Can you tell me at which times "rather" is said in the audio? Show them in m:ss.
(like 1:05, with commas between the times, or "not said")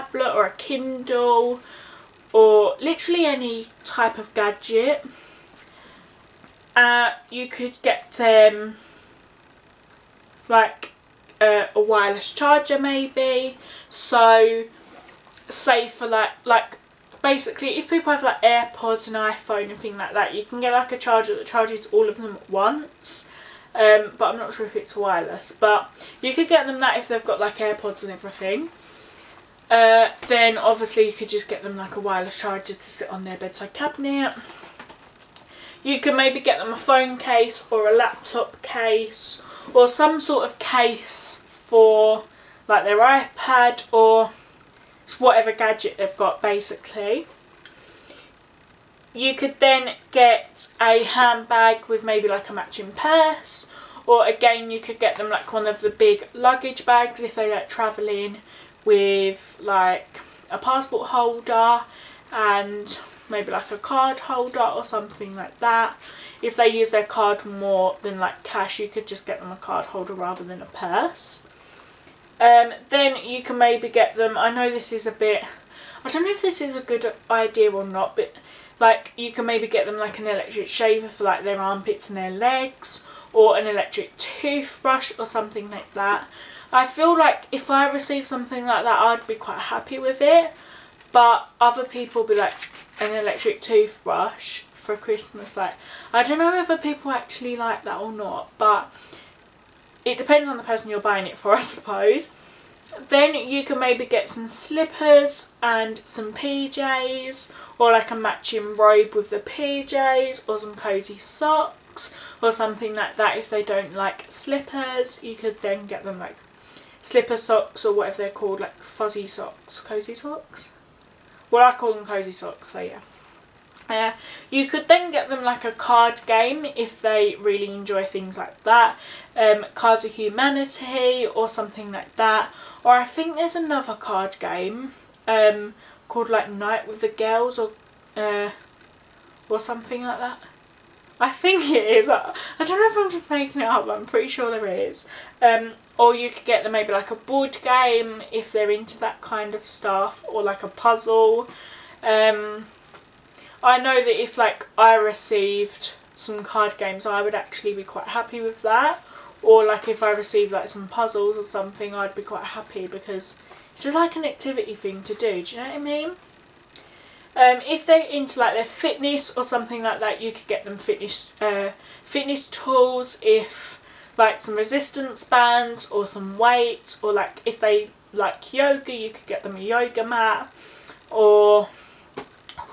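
1:10.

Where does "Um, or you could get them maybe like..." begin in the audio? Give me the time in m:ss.
2:25.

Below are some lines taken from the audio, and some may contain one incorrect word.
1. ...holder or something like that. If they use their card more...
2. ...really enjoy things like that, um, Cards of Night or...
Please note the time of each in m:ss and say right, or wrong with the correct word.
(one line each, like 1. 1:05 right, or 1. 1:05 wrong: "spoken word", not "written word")
1. 1:04 right
2. 2:07 wrong: "Humanity", not "Night".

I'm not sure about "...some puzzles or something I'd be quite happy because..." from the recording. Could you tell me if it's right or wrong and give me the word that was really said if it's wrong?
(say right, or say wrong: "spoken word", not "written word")
right.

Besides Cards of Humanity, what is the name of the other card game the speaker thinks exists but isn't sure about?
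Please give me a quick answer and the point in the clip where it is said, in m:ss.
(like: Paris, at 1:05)
Night with the Girls, at 2:16.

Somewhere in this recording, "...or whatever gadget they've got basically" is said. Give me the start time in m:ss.
0:43.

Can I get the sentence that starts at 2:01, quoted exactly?
Well, I call them cosy socks, so yeah.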